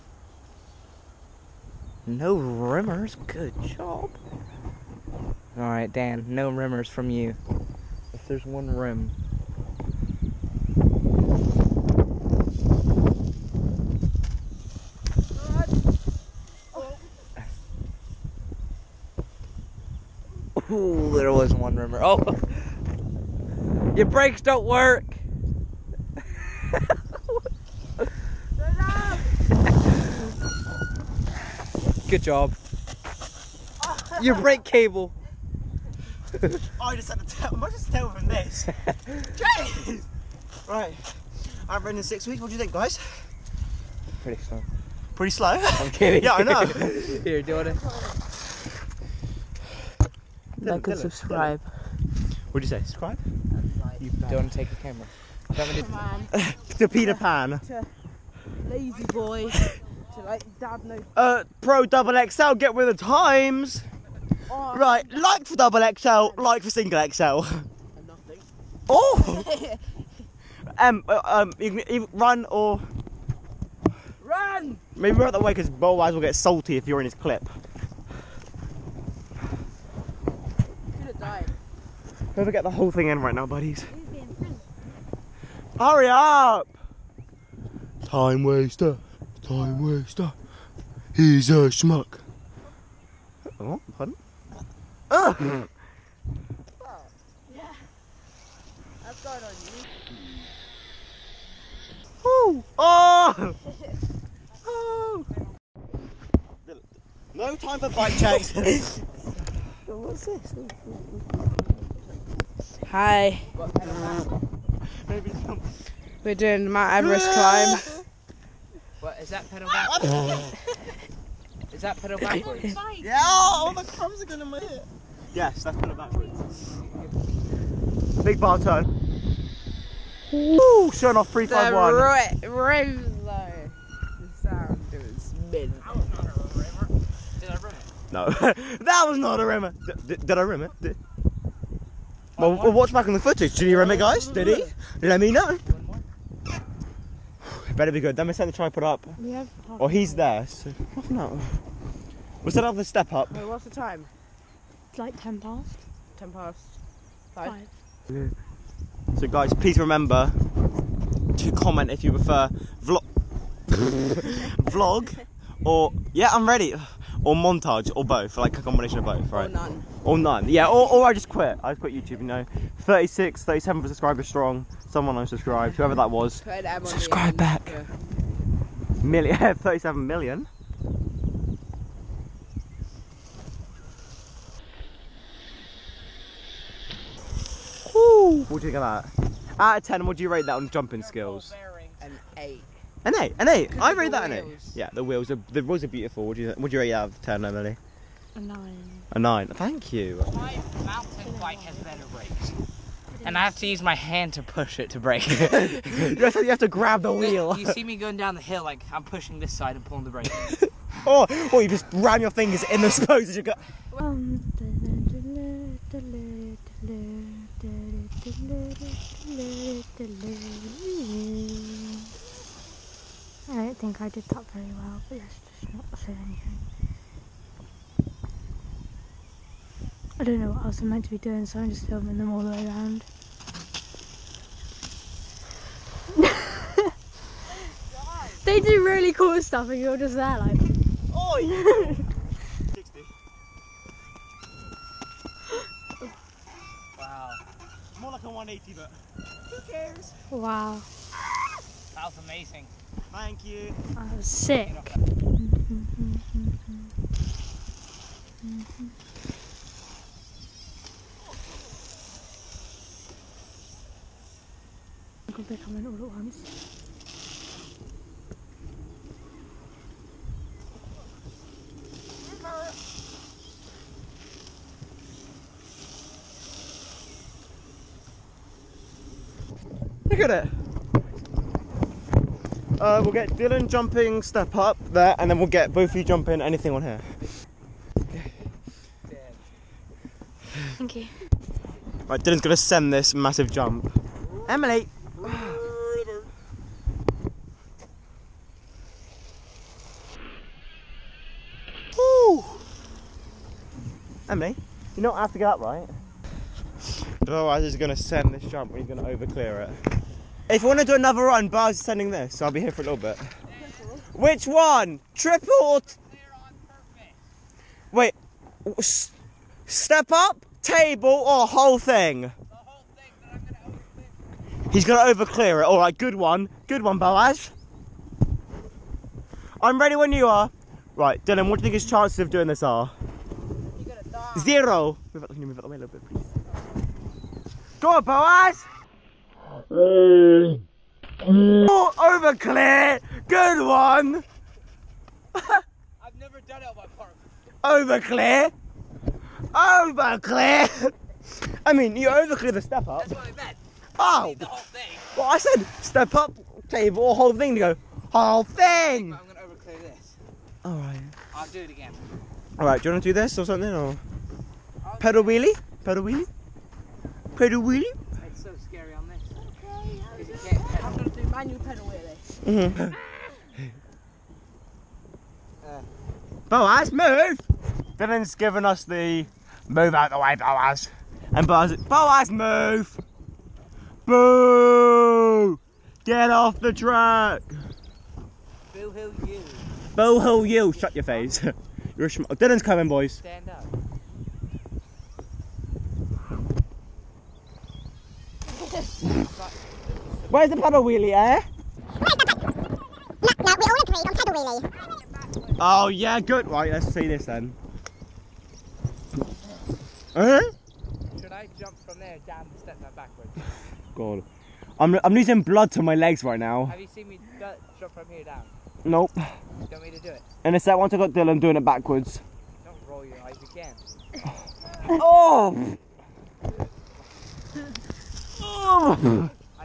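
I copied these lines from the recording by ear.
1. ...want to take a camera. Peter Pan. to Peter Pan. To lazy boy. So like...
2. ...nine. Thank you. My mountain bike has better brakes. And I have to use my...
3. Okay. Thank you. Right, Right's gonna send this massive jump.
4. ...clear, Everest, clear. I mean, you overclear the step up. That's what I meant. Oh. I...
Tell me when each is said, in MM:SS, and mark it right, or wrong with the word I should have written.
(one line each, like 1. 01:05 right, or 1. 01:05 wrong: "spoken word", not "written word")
1. 00:54 right
2. 03:19 right
3. 04:47 wrong: "Dylan", not "Right"
4. 05:47 wrong: "Over", not "Everest".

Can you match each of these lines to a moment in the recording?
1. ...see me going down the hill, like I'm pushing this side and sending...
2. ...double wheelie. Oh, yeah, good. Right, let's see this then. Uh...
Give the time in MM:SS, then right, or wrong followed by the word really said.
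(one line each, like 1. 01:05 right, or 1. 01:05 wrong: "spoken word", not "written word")
1. 03:27 wrong: "pulling", not "sending"
2. 06:44 wrong: "paddle", not "double".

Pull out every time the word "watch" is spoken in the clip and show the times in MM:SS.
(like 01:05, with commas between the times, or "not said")
02:22.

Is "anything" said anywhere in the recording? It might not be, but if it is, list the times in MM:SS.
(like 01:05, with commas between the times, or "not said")
03:46, 04:46.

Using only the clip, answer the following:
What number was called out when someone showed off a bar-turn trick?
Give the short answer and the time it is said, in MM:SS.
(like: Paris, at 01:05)
351, at 02:11.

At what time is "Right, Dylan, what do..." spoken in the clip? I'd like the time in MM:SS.
05:30.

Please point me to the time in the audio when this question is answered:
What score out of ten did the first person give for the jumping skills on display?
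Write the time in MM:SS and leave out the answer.
03:13.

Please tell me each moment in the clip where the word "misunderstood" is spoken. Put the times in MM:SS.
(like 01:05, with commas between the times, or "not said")
not said.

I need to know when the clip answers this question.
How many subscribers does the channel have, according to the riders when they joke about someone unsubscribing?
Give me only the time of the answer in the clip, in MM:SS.
02:53.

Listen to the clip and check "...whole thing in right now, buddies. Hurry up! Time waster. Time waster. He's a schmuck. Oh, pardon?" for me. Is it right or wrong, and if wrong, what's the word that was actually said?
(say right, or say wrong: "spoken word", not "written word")
right.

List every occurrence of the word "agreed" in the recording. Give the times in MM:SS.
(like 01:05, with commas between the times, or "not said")
06:43.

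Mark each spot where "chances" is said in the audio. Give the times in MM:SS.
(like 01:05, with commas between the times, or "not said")
05:31.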